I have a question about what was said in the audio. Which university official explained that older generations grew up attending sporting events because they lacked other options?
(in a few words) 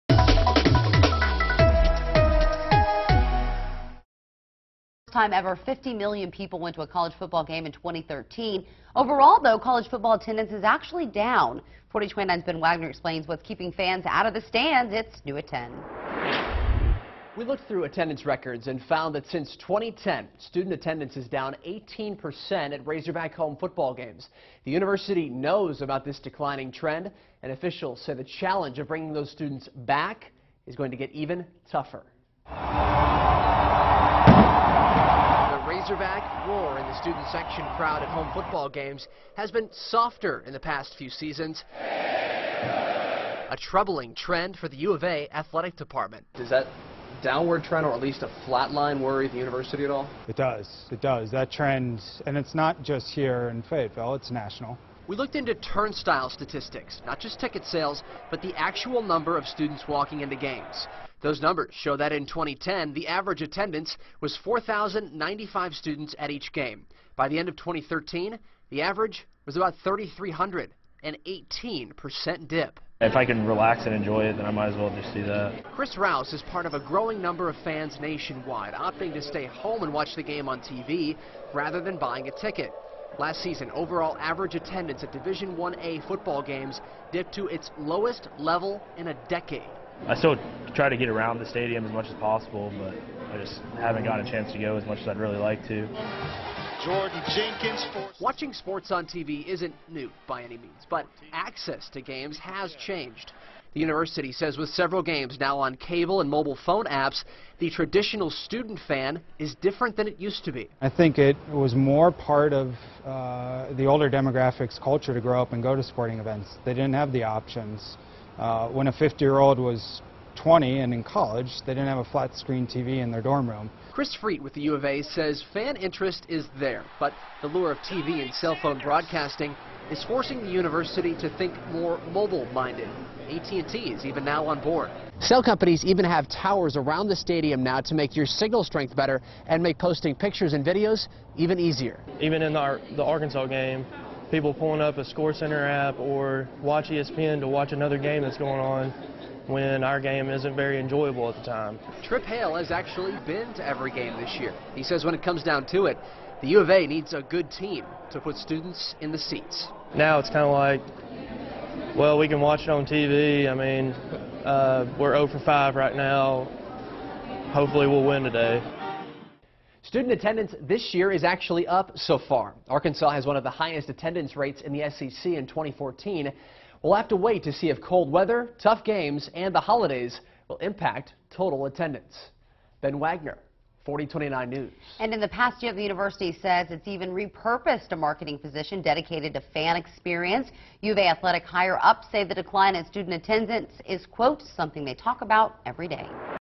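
Chris Freet.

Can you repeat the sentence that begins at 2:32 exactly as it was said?
Trip Hale has actually been to every game this year.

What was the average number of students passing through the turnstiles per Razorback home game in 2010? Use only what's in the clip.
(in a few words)
4,095.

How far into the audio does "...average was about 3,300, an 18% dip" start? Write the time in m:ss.
1:08.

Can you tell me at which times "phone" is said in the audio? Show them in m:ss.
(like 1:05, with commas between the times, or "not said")
1:46, 2:08.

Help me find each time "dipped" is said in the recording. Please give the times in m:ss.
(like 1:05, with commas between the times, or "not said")
1:27.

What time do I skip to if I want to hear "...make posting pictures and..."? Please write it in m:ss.
2:19.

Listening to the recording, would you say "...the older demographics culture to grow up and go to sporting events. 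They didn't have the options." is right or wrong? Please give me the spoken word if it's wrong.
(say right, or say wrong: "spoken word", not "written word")
right.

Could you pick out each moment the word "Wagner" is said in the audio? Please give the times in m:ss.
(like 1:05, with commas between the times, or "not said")
0:12, 3:02.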